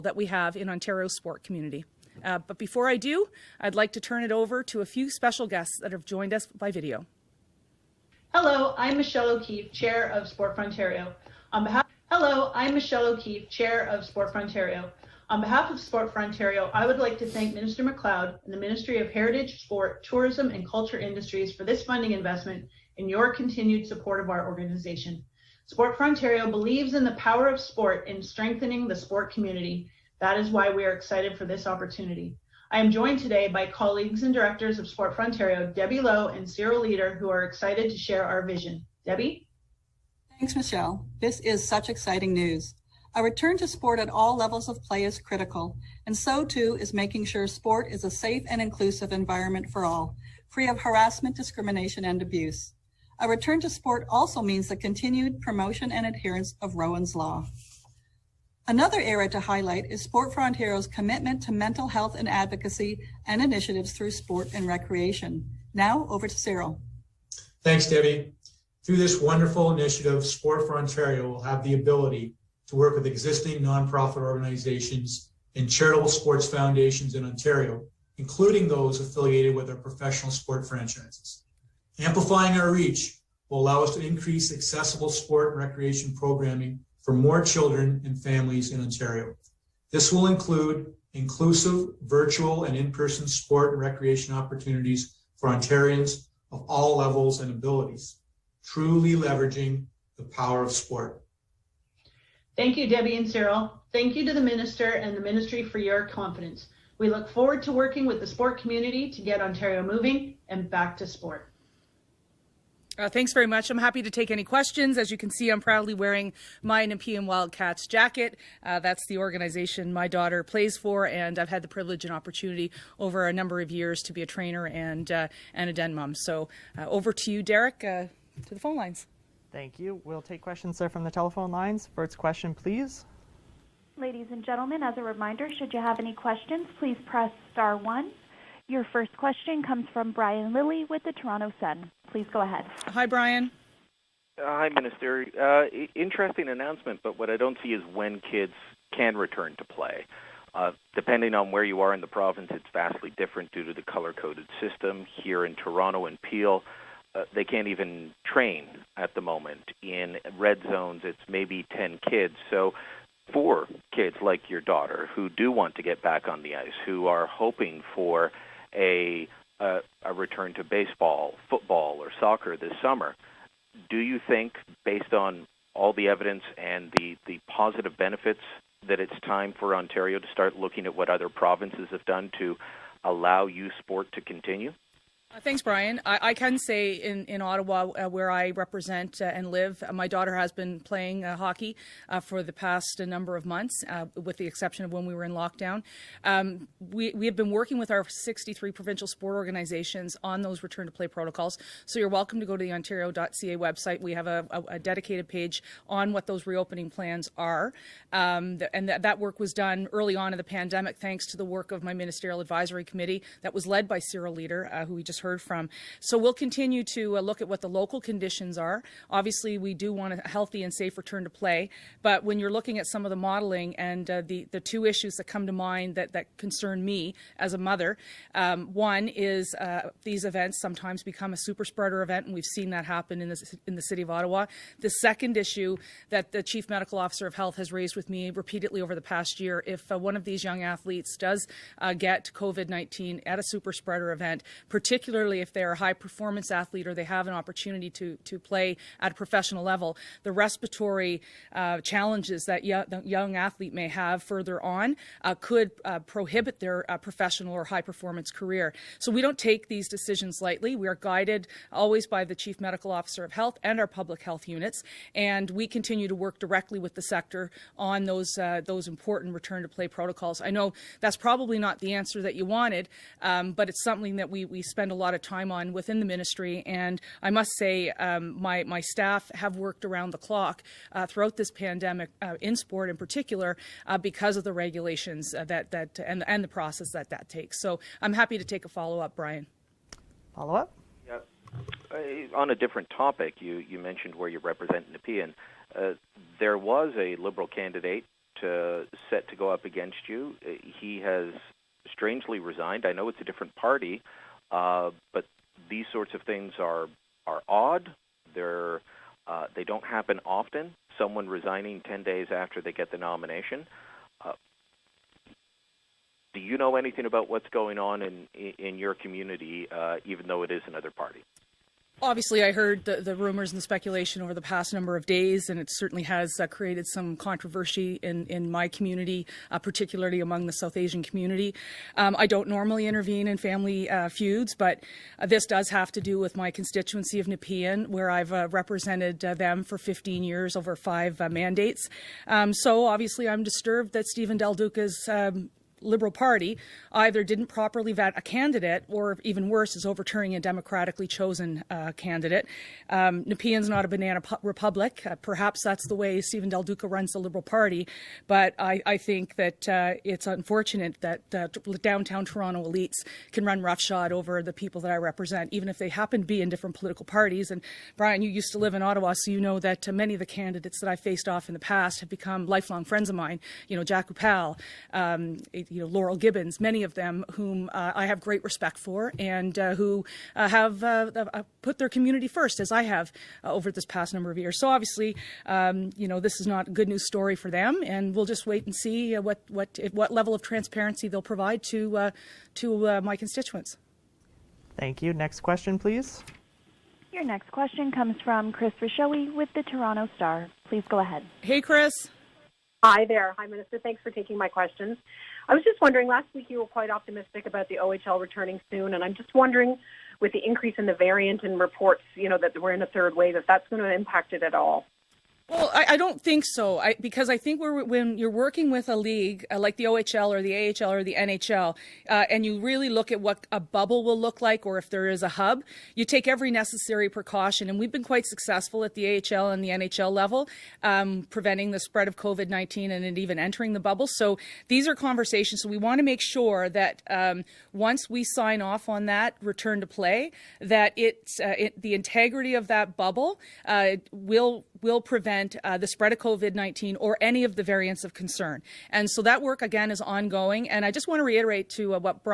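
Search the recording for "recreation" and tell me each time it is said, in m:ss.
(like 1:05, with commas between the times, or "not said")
1:04, 1:25, 1:33.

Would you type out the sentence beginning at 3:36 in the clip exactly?
So we'll continue to uh, look at what the local conditions are.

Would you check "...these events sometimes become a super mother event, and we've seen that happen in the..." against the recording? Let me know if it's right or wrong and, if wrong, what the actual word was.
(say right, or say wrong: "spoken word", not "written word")
wrong: "spreader", not "mother".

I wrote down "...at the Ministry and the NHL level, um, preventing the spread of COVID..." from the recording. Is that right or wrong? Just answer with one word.
wrong.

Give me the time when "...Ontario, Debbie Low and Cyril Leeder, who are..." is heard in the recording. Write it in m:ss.
0:35.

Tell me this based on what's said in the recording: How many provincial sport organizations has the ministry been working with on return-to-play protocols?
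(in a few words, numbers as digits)
63.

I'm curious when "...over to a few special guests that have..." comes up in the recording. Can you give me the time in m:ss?
0:04.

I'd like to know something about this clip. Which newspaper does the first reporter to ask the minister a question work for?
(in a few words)
Toronto Sun.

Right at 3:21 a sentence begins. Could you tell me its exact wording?
So you're welcome to go to the Ontario.ca website.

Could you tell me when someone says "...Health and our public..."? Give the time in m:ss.
4:23.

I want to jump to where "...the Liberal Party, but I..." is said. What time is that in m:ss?
5:57.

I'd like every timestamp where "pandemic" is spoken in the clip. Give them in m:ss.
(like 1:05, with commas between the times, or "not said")
3:30, 4:41.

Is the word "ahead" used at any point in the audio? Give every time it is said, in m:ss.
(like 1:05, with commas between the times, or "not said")
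2:22, 6:40.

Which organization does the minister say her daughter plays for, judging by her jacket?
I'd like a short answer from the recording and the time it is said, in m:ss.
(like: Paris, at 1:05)
Nepean Wildcats, at 1:56.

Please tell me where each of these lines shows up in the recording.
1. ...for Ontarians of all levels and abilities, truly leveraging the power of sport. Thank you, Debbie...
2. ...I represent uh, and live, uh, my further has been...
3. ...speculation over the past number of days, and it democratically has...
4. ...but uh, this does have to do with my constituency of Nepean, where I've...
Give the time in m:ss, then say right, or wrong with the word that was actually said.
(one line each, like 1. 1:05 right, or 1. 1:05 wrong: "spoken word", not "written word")
1. 1:35 right
2. 3:08 wrong: "daughter", not "further"
3. 5:23 wrong: "certainly", not "democratically"
4. 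5:34 right.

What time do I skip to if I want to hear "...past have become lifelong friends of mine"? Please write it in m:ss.
6:11.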